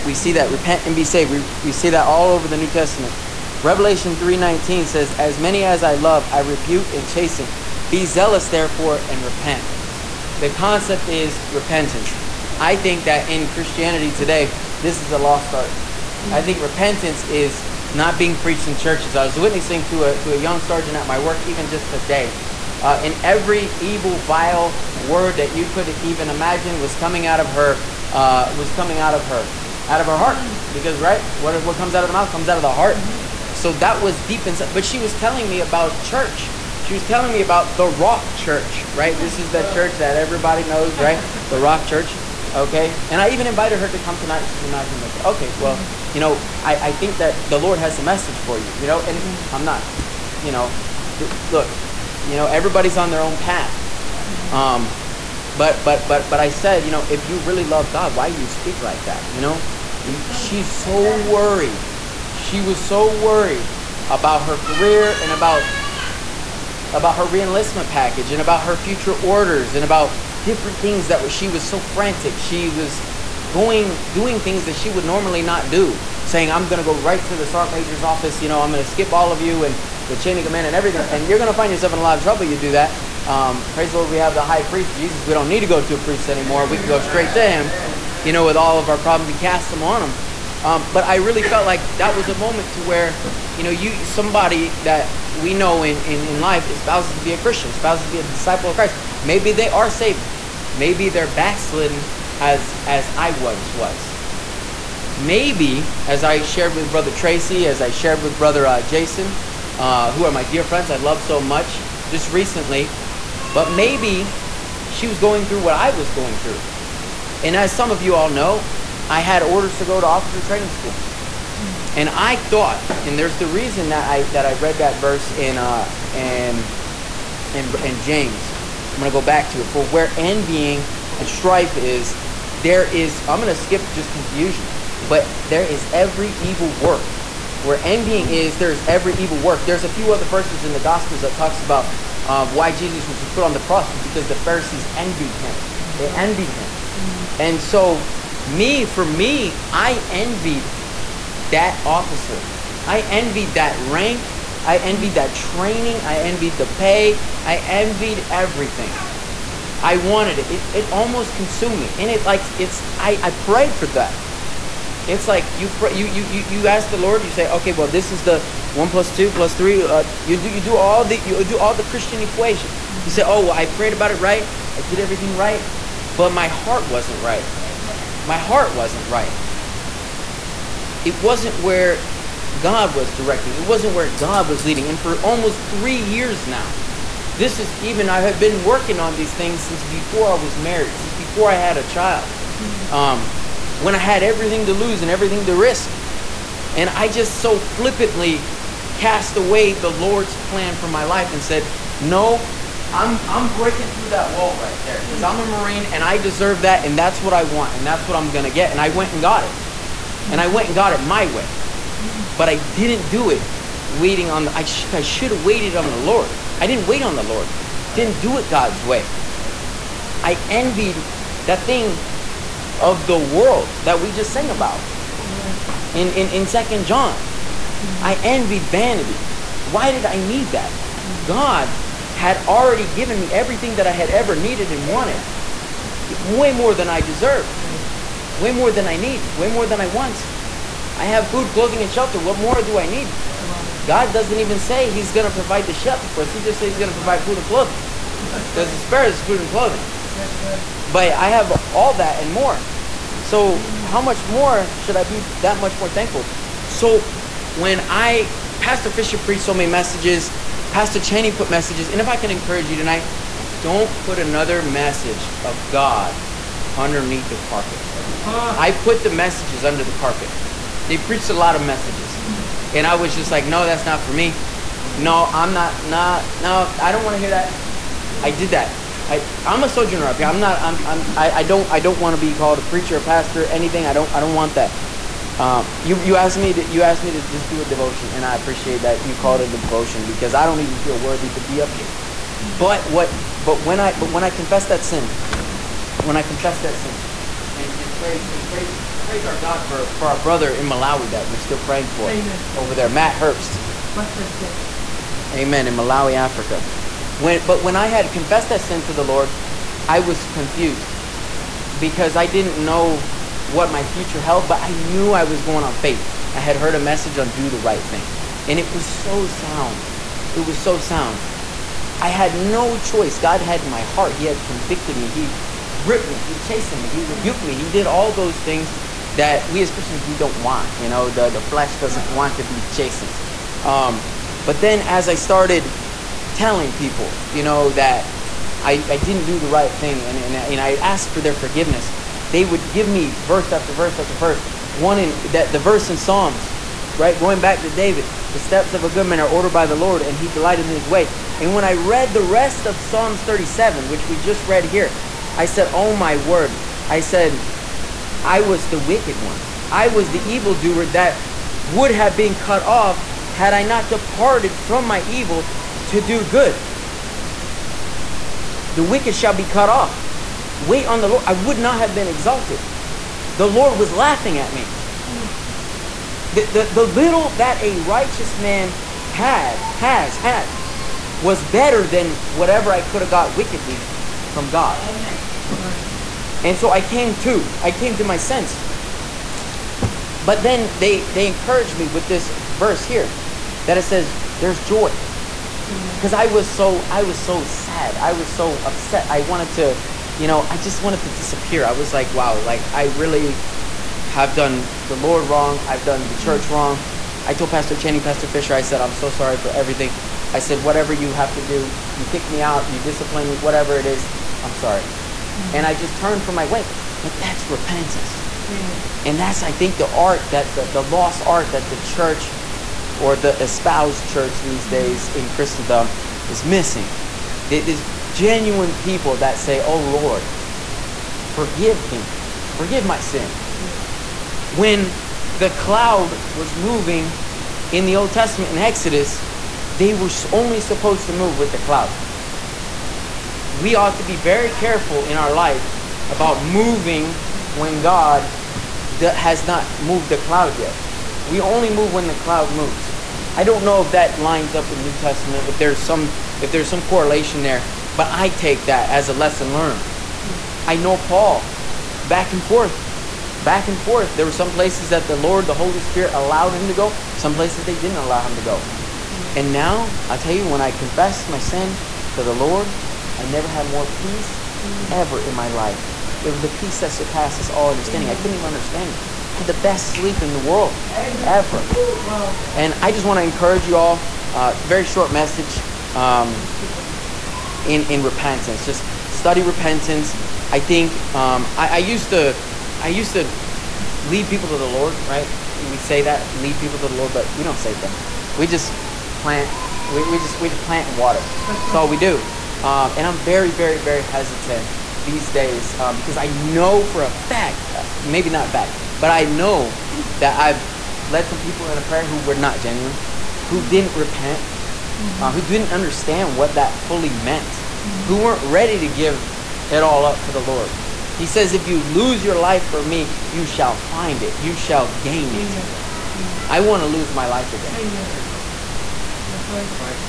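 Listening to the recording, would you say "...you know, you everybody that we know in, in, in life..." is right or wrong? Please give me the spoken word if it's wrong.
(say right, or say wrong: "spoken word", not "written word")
wrong: "somebody", not "everybody".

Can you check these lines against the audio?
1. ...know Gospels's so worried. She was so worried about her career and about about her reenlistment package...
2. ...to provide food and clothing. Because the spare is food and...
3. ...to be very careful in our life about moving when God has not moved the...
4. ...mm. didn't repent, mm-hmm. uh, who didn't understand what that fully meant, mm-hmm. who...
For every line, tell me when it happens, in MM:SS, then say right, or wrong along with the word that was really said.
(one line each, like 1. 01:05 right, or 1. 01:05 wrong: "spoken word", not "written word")
1. 00:59 wrong: "She", not "Gospels"
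2. 04:06 right
3. 07:23 right
4. 08:33 right.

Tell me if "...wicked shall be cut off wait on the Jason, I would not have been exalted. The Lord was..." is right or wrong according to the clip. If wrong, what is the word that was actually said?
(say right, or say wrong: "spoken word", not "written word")
wrong: "Lord", not "Jason".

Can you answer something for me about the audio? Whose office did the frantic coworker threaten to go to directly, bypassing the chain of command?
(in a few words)
Sergeant major.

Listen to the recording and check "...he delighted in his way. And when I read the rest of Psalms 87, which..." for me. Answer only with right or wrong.
wrong.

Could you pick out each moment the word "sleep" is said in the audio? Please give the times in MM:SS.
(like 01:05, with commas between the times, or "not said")
07:59.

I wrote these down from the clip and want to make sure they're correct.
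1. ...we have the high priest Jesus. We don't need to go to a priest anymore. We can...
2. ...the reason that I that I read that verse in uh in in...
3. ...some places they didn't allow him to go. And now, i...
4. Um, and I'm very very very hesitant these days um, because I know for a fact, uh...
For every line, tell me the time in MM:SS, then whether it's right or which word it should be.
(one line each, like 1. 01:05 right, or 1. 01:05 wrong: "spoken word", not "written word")
1. 01:24 right
2. 02:03 right
3. 07:47 right
4. 08:22 right.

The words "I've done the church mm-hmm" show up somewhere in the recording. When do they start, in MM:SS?
06:45.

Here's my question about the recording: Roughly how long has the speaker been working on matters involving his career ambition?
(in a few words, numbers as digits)
Almost 3 years.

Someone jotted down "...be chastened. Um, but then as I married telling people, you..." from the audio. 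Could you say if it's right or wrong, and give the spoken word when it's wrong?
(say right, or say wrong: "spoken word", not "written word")
wrong: "started", not "married".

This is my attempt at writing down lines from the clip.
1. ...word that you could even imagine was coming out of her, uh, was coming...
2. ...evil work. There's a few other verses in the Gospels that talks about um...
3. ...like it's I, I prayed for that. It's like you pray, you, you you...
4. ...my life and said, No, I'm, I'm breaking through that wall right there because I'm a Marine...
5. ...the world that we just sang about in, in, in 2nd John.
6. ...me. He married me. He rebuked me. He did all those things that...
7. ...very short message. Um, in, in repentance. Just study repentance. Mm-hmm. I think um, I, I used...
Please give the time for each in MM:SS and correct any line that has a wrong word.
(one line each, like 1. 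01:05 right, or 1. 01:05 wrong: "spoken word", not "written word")
1. 00:25 right
2. 02:19 right
3. 02:42 right
4. 03:20 right
5. 03:43 right
6. 05:26 wrong: "chastened", not "married"
7. 08:04 right.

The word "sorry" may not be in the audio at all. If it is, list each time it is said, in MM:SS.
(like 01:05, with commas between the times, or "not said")
06:49, 06:54.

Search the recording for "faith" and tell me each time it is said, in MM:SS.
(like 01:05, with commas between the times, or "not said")
05:15.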